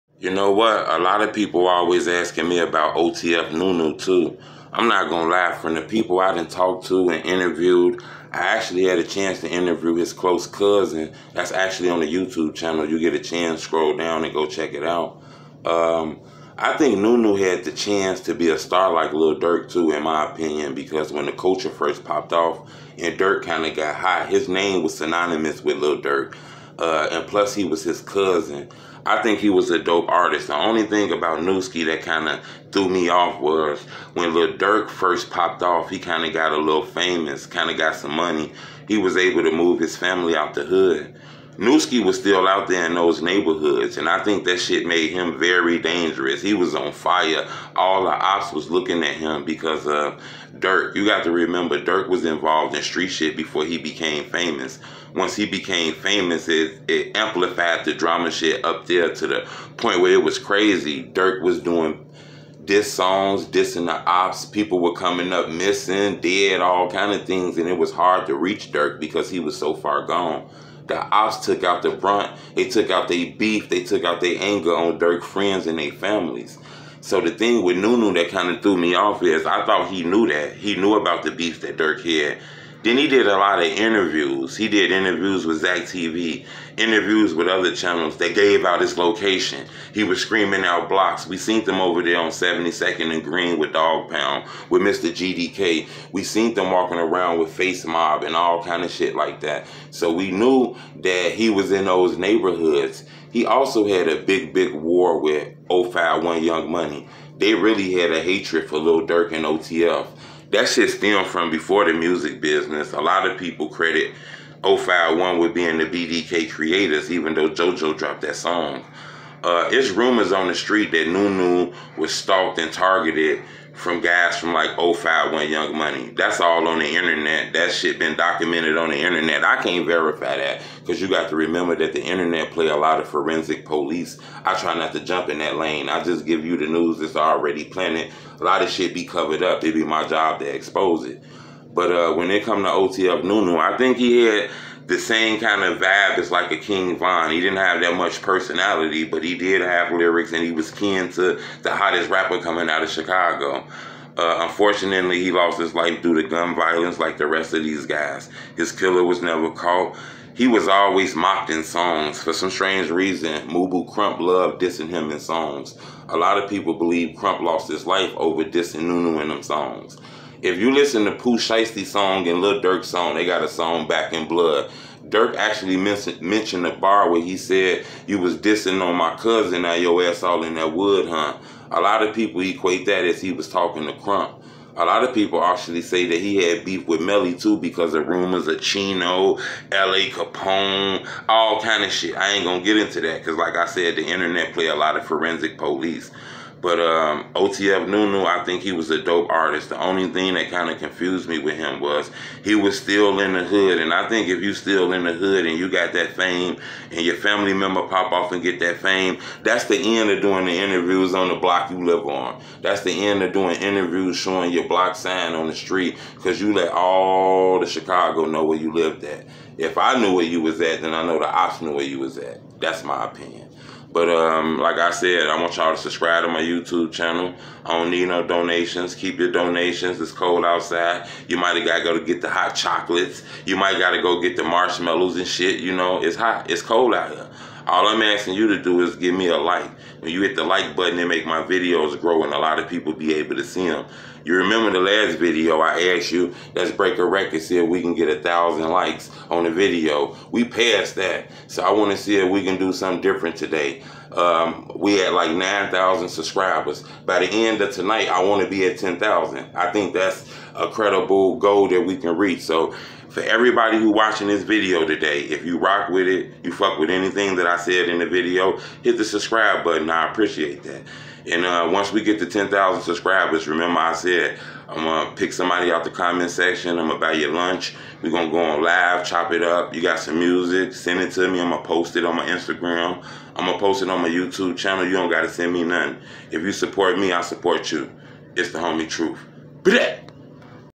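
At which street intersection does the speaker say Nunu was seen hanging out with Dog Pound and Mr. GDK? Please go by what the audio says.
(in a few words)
72nd and Green.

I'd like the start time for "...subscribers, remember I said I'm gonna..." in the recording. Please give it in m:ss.
4:32.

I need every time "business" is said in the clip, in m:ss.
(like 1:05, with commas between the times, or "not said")
1:52.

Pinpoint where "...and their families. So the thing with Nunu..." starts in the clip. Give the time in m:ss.
1:15.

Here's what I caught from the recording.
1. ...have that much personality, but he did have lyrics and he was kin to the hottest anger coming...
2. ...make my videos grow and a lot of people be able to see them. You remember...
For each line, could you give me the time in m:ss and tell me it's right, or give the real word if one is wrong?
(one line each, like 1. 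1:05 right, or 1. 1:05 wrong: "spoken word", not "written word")
1. 2:27 wrong: "rapper", not "anger"
2. 4:01 right.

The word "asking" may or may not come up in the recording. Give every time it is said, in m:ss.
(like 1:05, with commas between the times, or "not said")
0:02, 3:58.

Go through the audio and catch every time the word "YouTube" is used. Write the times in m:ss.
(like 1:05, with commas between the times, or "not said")
0:12, 3:46, 4:44.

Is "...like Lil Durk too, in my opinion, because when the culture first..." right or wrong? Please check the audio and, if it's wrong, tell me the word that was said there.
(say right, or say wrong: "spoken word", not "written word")
right.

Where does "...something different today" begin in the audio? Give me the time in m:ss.
4:12.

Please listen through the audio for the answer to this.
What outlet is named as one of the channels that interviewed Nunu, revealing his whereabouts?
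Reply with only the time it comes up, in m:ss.
1:25.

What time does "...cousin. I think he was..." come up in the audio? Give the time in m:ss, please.
0:28.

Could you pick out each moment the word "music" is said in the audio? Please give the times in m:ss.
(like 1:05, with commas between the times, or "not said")
1:51, 4:40.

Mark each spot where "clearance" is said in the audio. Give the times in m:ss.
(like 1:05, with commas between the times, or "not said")
not said.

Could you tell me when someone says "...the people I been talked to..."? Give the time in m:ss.
0:05.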